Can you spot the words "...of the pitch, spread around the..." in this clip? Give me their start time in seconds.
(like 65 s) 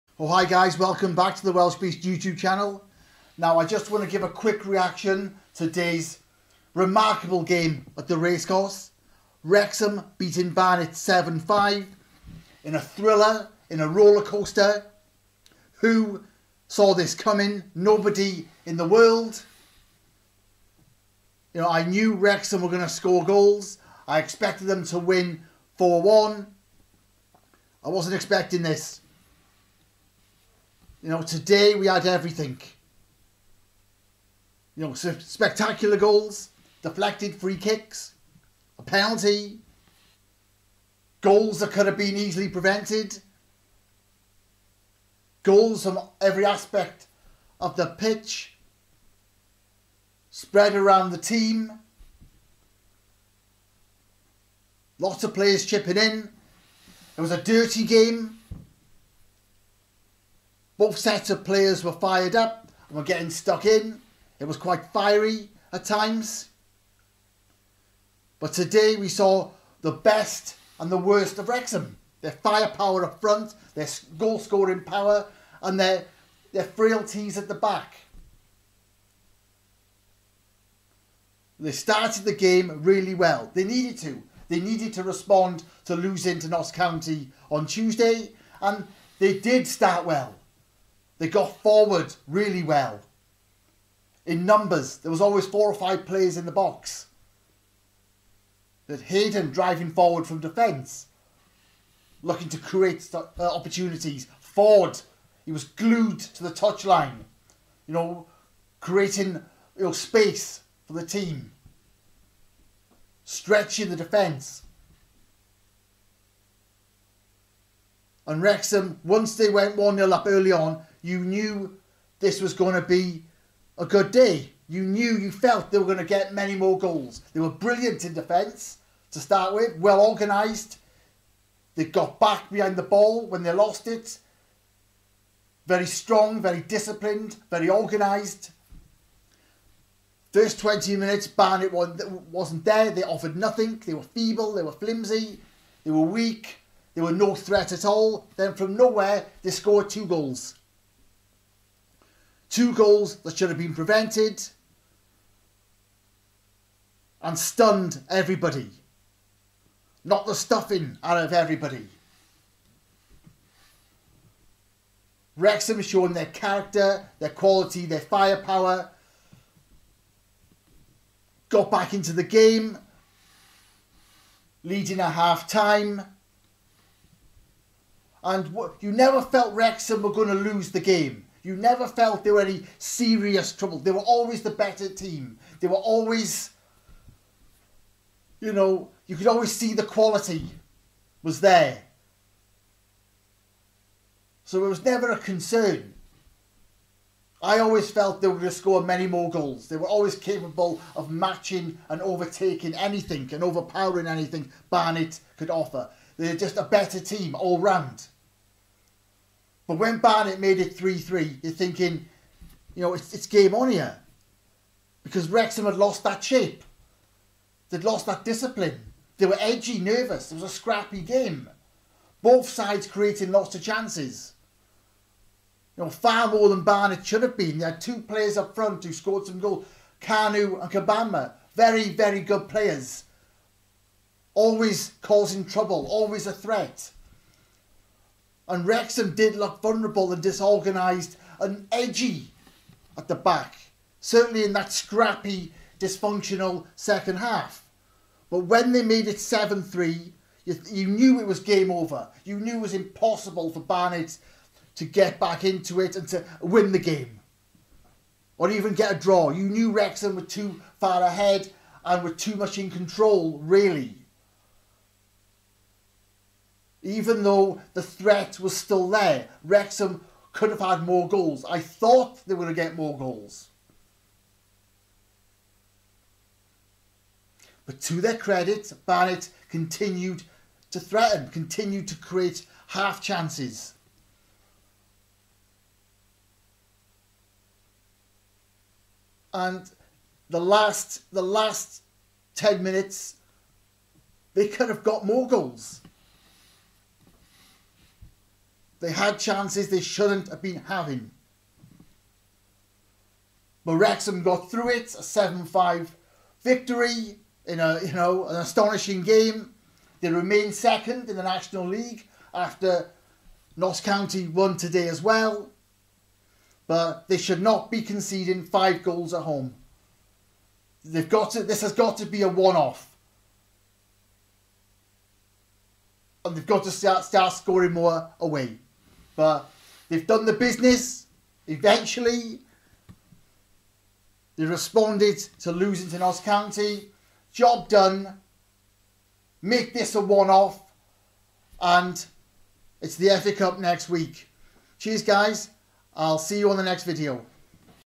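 47 s.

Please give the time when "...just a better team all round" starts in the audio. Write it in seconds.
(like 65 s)
206 s.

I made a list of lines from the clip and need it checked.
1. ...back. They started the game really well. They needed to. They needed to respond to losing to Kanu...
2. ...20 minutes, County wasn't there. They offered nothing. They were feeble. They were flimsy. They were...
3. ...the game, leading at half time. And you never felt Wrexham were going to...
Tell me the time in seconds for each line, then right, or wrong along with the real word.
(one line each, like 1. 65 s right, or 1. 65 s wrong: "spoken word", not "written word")
1. 77 s wrong: "Notts", not "Kanu"
2. 140 s wrong: "Barnet", not "County"
3. 172 s right.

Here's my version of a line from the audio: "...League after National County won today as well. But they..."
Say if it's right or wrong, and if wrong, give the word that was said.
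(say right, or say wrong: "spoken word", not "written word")
wrong: "Notts", not "National".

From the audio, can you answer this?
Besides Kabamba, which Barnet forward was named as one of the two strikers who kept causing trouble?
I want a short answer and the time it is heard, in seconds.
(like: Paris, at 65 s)
Kanu, at 230 s.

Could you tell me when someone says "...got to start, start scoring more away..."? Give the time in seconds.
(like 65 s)
326 s.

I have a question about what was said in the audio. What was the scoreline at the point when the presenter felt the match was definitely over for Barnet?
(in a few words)
7-3.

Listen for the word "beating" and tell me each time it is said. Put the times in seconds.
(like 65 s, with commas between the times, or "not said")
10 s.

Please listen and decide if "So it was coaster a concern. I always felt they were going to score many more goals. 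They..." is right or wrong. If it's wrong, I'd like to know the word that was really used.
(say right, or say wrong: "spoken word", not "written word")
wrong: "never", not "coaster".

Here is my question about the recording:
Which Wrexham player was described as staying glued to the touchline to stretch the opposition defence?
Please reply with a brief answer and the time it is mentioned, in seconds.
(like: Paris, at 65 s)
Ford, at 104 s.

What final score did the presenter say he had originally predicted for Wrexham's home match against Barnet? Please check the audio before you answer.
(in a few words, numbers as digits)
4-1.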